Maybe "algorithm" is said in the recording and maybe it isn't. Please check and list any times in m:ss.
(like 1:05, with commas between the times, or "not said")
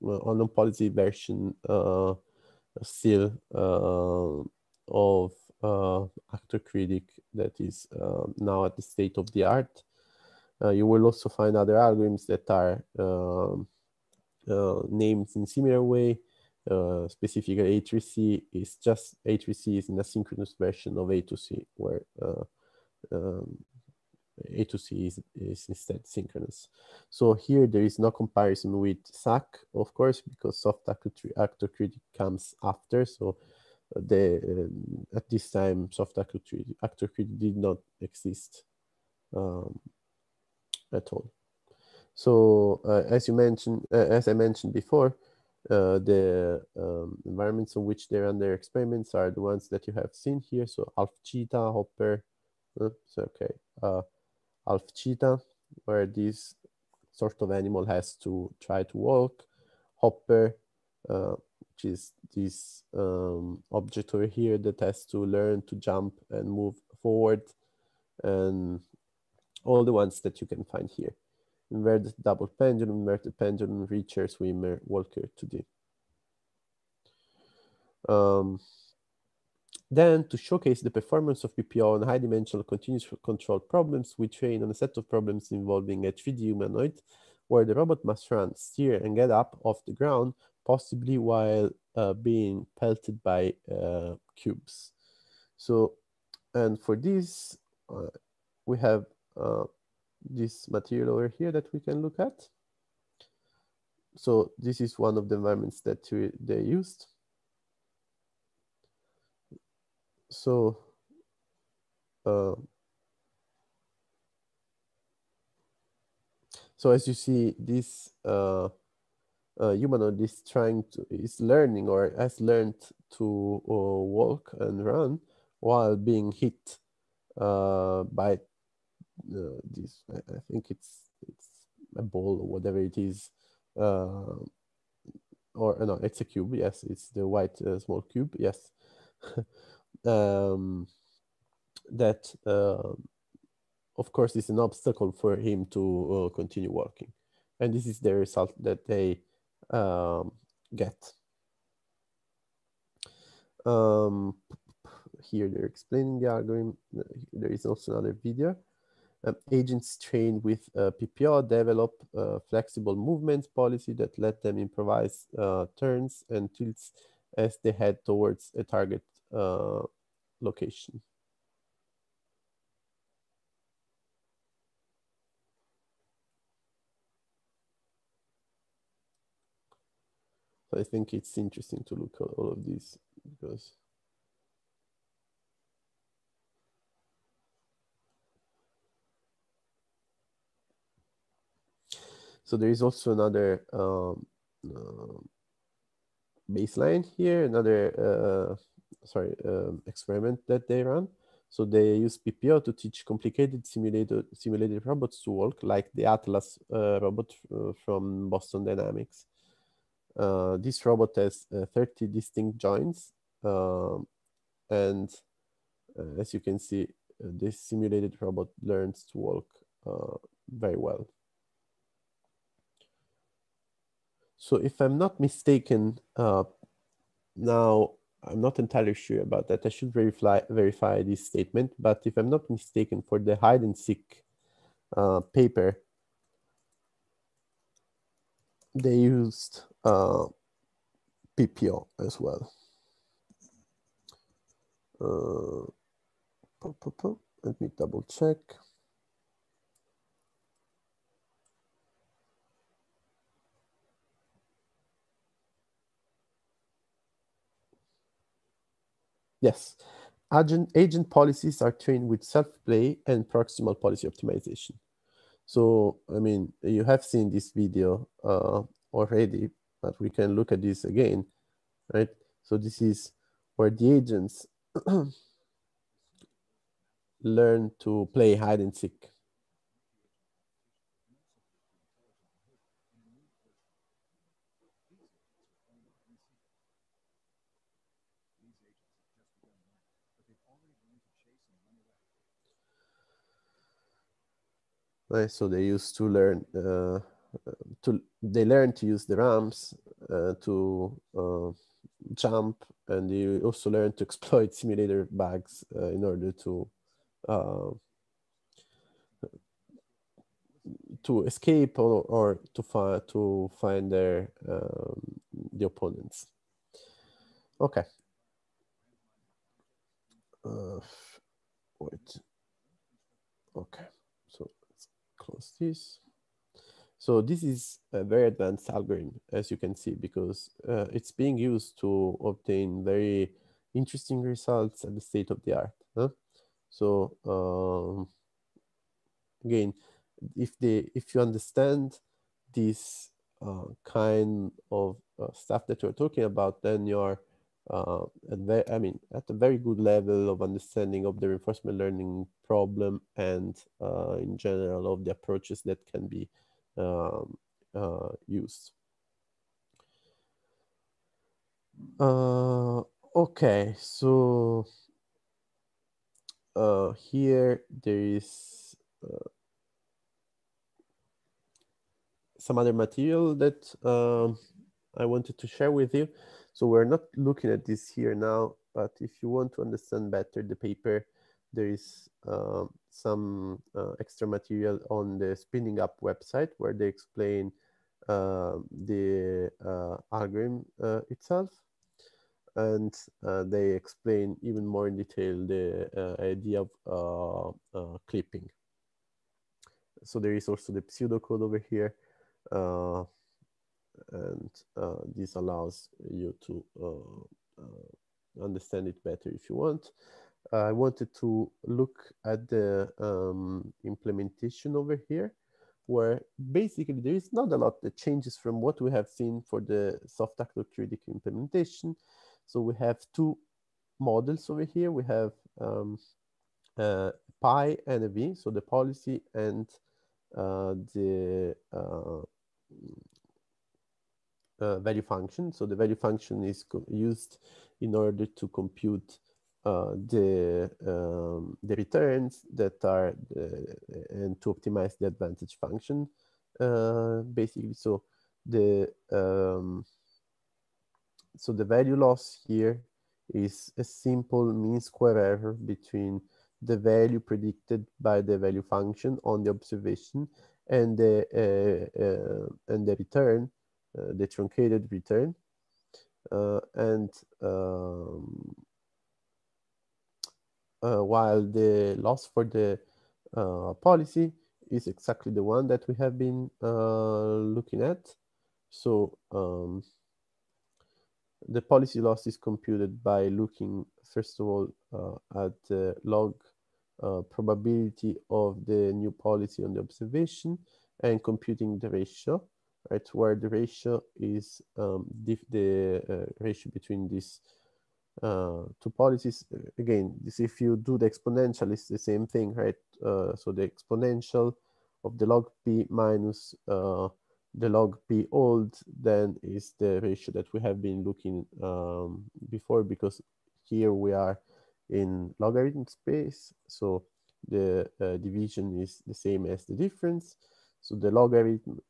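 0:11, 2:36, 5:28, 6:30.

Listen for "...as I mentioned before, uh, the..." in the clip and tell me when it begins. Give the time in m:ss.
0:43.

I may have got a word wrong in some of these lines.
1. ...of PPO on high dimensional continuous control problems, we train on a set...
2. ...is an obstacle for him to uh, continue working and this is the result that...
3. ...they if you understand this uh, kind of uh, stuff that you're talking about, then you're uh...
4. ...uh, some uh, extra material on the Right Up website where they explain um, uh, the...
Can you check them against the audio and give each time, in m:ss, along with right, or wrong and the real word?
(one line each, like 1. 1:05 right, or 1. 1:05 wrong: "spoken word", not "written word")
1. 1:21 right
2. 2:24 right
3. 5:40 right
4. 6:22 wrong: "Spinning", not "Right".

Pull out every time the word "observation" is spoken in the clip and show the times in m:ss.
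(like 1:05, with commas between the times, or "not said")
7:39, 8:09.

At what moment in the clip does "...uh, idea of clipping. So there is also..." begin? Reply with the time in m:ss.
6:35.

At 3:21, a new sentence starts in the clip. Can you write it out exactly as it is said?
So they use PPO to teach complicated simulated, simulated robots to walk, like the Atlas uh, robot uh, from Boston Dynamics.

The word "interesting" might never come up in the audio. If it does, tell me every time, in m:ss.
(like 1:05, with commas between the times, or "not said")
3:01, 5:33.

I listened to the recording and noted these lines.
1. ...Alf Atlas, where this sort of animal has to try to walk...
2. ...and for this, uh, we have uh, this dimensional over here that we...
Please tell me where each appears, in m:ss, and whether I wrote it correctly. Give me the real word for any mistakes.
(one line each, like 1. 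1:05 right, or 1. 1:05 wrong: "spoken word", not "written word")
1. 0:54 wrong: "Cheetah", not "Atlas"
2. 1:36 wrong: "material", not "dimensional".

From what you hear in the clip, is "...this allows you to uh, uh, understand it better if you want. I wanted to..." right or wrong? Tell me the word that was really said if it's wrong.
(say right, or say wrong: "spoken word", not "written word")
right.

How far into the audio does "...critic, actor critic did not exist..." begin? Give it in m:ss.
0:36.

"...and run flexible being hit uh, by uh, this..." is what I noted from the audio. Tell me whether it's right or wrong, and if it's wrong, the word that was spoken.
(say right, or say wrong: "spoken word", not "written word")
wrong: "while", not "flexible".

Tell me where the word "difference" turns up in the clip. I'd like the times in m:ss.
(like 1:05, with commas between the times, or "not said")
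8:39.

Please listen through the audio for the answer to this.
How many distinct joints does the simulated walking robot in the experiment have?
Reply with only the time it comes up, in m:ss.
3:31.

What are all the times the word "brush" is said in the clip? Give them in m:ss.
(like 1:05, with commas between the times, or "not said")
not said.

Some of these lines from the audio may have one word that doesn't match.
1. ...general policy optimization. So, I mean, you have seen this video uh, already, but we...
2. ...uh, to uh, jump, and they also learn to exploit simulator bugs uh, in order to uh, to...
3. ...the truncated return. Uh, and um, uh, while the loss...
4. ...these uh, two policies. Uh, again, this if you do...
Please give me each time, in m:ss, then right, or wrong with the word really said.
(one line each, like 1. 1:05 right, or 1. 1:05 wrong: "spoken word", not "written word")
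1. 4:23 wrong: "proximal", not "general"
2. 5:00 right
3. 7:44 right
4. 8:17 right.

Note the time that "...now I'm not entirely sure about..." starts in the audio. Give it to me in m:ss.
3:47.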